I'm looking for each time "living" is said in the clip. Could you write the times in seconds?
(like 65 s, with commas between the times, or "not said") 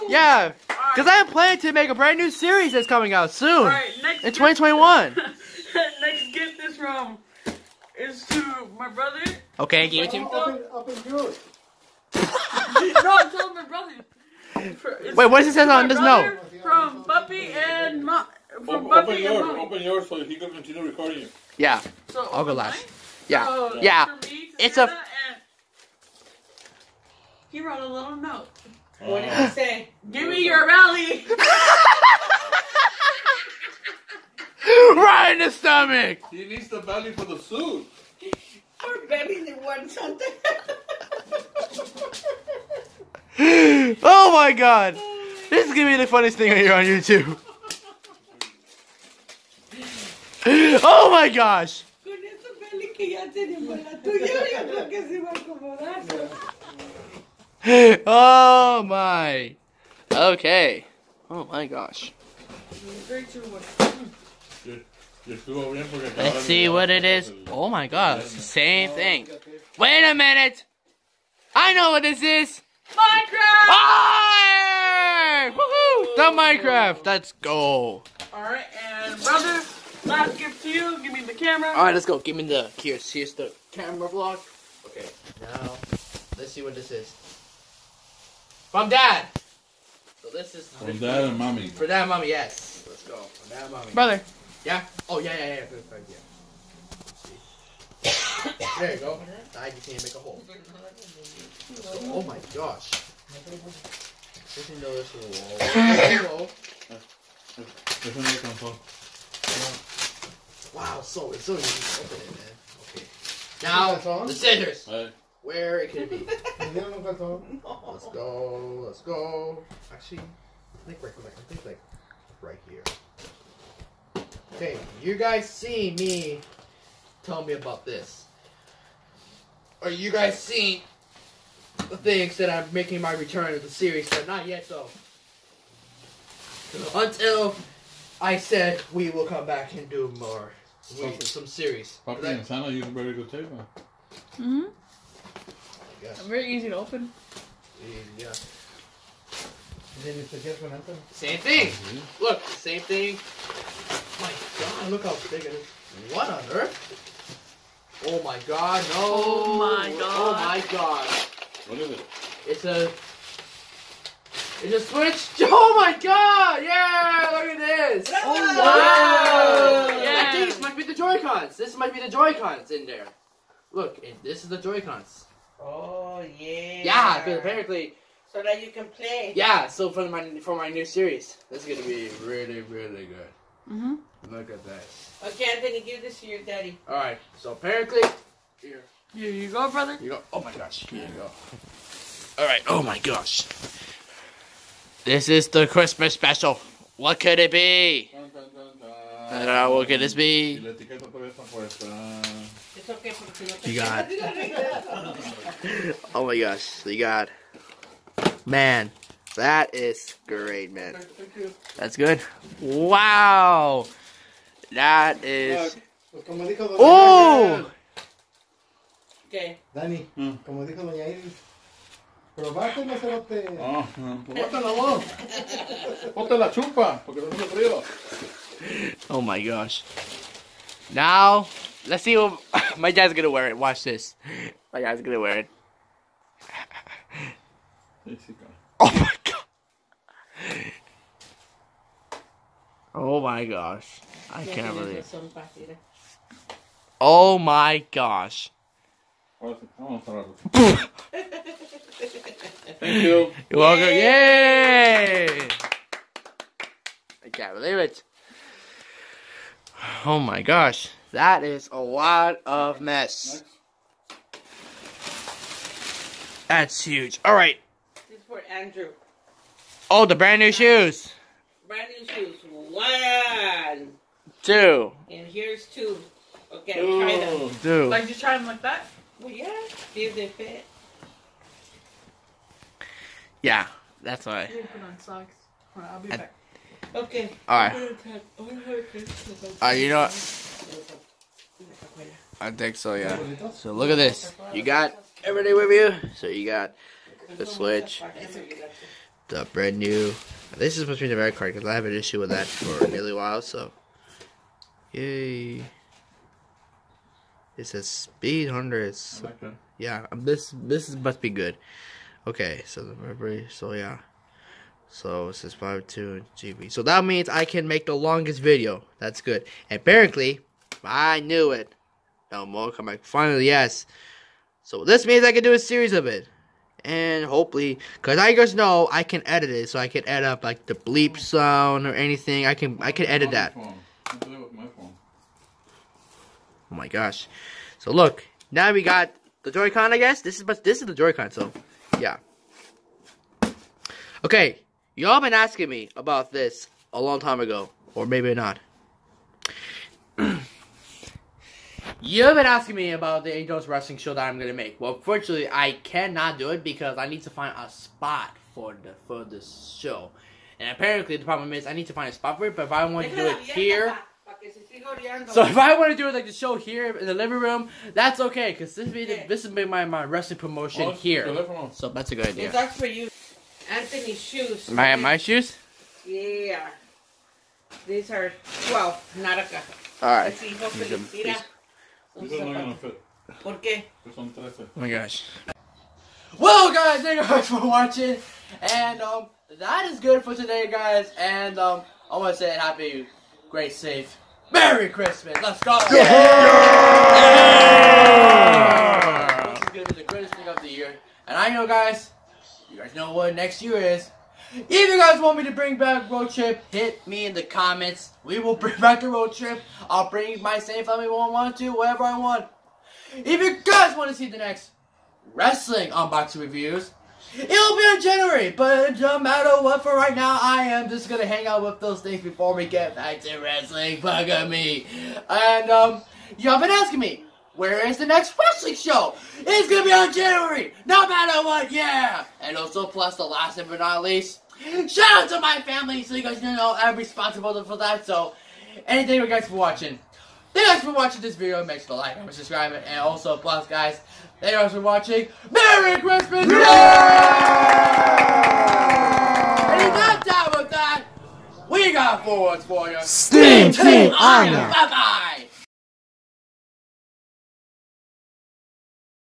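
367 s.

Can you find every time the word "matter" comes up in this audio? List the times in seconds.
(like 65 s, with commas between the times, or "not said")
419 s, 431 s.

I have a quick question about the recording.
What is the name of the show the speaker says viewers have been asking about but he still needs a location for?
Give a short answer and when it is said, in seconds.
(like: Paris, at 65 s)
Angels Wrestling Show, at 353 s.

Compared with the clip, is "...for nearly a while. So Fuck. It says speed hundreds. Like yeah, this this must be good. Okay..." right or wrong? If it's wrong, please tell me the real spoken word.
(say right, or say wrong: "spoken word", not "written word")
wrong: "Yay", not "Fuck".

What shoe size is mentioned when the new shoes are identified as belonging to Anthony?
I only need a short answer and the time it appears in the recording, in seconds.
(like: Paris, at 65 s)
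12, at 378 s.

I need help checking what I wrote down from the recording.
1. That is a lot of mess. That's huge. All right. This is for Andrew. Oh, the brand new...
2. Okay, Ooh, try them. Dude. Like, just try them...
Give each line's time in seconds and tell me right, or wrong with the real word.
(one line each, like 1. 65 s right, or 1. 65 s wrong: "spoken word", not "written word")
1. 261 s right
2. 276 s right.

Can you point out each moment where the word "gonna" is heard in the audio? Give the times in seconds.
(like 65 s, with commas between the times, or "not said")
45 s, 181 s, 354 s, 421 s, 429 s.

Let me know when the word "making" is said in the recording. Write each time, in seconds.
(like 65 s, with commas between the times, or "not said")
132 s.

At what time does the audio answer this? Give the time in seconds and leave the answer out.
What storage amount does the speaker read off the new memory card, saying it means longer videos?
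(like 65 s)
315 s.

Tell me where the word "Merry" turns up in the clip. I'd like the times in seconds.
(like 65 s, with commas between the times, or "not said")
394 s, 445 s.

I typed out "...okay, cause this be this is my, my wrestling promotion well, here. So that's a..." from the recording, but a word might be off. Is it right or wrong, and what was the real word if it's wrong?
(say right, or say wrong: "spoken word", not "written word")
right.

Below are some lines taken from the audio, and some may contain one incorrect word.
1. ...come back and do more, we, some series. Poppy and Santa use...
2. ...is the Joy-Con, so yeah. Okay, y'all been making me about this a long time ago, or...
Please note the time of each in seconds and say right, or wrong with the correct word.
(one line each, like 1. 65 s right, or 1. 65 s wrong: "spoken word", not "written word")
1. 139 s right
2. 340 s wrong: "asking", not "making".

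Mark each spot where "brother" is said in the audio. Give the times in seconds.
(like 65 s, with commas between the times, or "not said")
8 s, 13 s, 79 s, 93 s, 189 s.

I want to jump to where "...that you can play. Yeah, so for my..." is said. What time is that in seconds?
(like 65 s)
178 s.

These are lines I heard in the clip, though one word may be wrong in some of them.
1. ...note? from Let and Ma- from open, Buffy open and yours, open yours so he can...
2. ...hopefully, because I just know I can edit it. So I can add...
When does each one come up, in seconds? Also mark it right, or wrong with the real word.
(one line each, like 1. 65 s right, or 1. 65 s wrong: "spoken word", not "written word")
1. 15 s wrong: "Buffy", not "Let"
2. 327 s right.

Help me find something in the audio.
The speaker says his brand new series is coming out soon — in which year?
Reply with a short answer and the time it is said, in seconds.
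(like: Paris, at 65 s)
2021, at 4 s.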